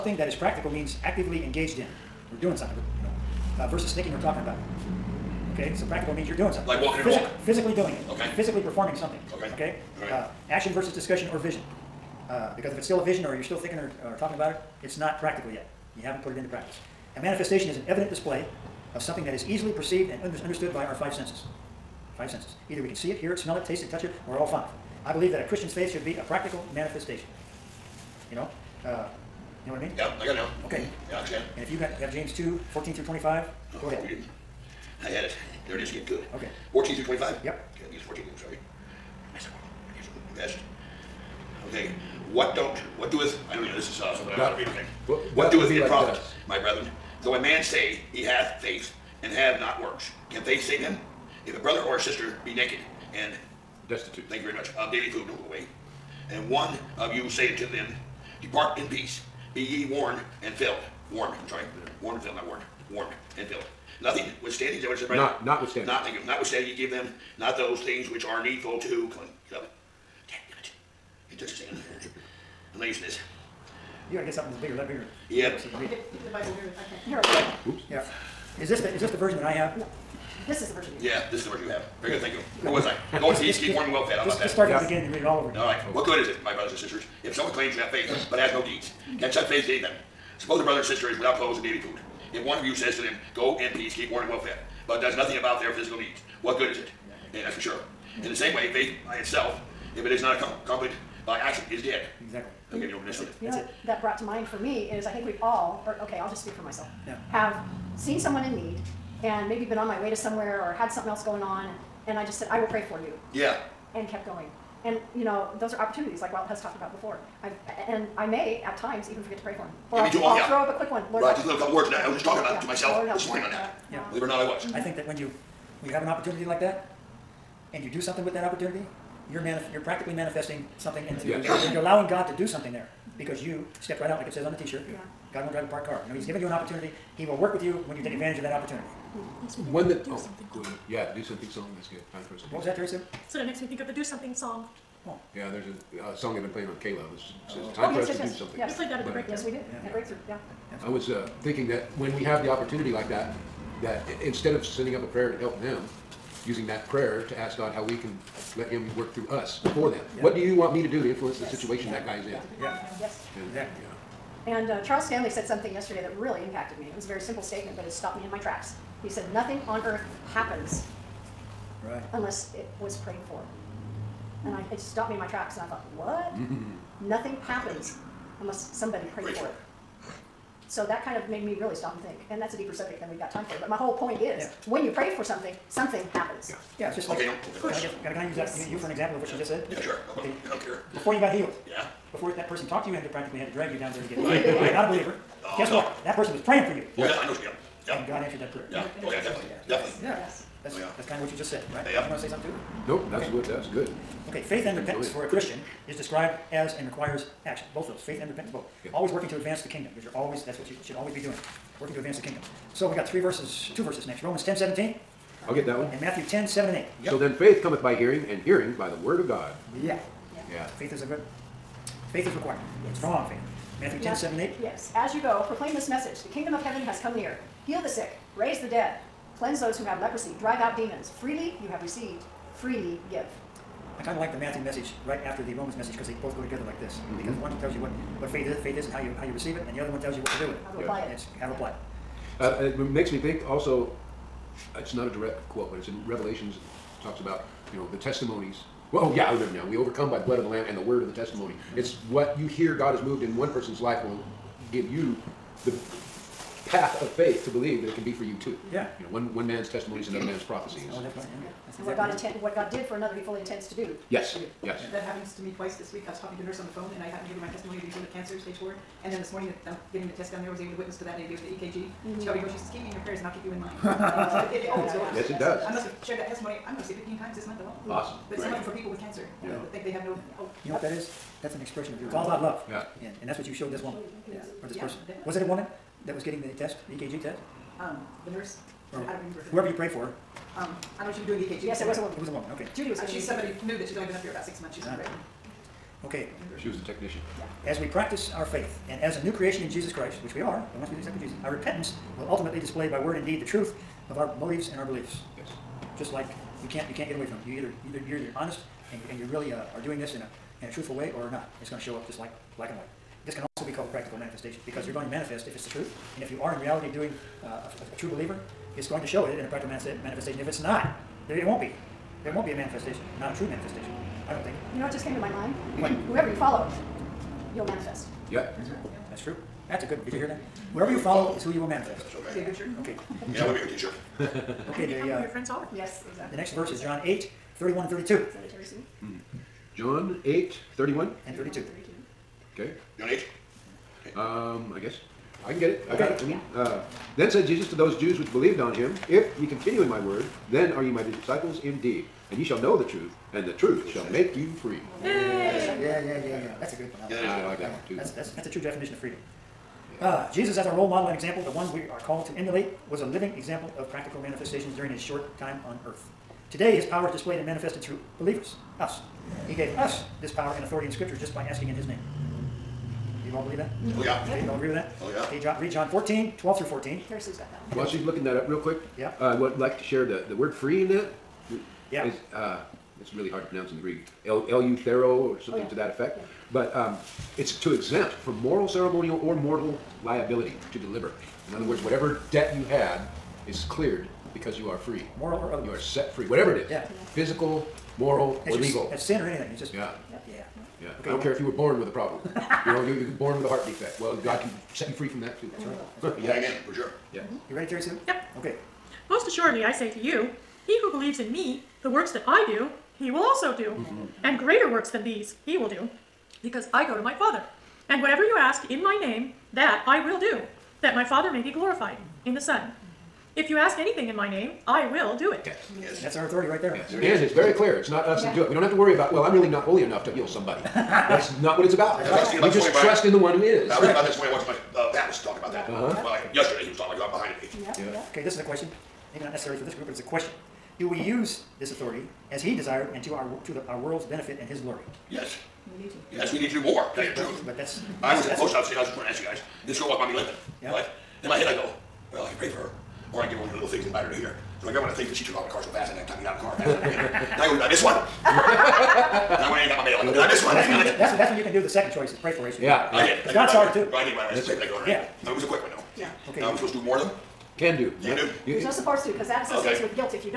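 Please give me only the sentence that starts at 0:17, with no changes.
A manifestation is an evident display of something that is easily perceived and under- understood by our five senses.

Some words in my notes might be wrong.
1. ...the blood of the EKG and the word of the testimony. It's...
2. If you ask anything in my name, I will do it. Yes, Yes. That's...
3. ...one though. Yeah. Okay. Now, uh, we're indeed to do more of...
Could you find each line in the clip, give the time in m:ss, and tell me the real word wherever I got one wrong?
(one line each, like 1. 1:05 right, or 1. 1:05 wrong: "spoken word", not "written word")
1. 4:10 wrong: "Lamb", not "EKG"
2. 7:03 right
3. 7:45 wrong: "supposed", not "indeed".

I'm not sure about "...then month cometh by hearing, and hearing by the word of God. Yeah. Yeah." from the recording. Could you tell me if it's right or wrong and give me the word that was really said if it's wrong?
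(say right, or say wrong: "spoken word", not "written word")
wrong: "faith", not "month".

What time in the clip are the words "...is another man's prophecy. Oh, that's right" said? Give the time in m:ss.
4:20.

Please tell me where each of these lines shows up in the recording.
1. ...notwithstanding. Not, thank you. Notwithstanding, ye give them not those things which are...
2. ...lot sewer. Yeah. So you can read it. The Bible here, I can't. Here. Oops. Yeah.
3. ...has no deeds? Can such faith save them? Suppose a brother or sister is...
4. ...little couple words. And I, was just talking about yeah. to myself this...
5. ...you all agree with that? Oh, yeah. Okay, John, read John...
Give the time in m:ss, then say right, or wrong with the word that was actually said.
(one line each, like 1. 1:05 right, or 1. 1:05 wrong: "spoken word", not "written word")
1. 1:05 right
2. 1:14 wrong: "bigger", not "sewer"
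3. 1:28 right
4. 2:01 right
5. 6:14 right.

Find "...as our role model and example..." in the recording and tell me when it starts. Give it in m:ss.
6:00.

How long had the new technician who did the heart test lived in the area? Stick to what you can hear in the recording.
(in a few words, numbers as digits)
about 6 months.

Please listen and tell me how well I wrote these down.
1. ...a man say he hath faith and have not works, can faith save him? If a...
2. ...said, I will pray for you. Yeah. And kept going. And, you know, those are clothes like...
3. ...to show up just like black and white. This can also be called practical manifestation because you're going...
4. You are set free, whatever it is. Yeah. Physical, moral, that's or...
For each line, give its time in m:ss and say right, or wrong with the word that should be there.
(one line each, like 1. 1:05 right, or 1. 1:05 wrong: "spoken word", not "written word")
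1. 0:47 right
2. 1:52 wrong: "opportunities", not "clothes"
3. 5:11 right
4. 6:35 right.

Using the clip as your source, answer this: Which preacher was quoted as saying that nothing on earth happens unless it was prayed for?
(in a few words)
Charles Stanley.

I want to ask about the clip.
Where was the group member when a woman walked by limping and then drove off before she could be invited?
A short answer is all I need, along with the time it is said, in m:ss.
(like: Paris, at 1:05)
post office, at 7:28.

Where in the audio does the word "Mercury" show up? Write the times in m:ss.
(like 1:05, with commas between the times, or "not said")
not said.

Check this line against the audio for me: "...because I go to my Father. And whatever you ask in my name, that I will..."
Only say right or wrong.
right.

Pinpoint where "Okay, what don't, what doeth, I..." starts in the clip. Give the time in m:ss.
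0:41.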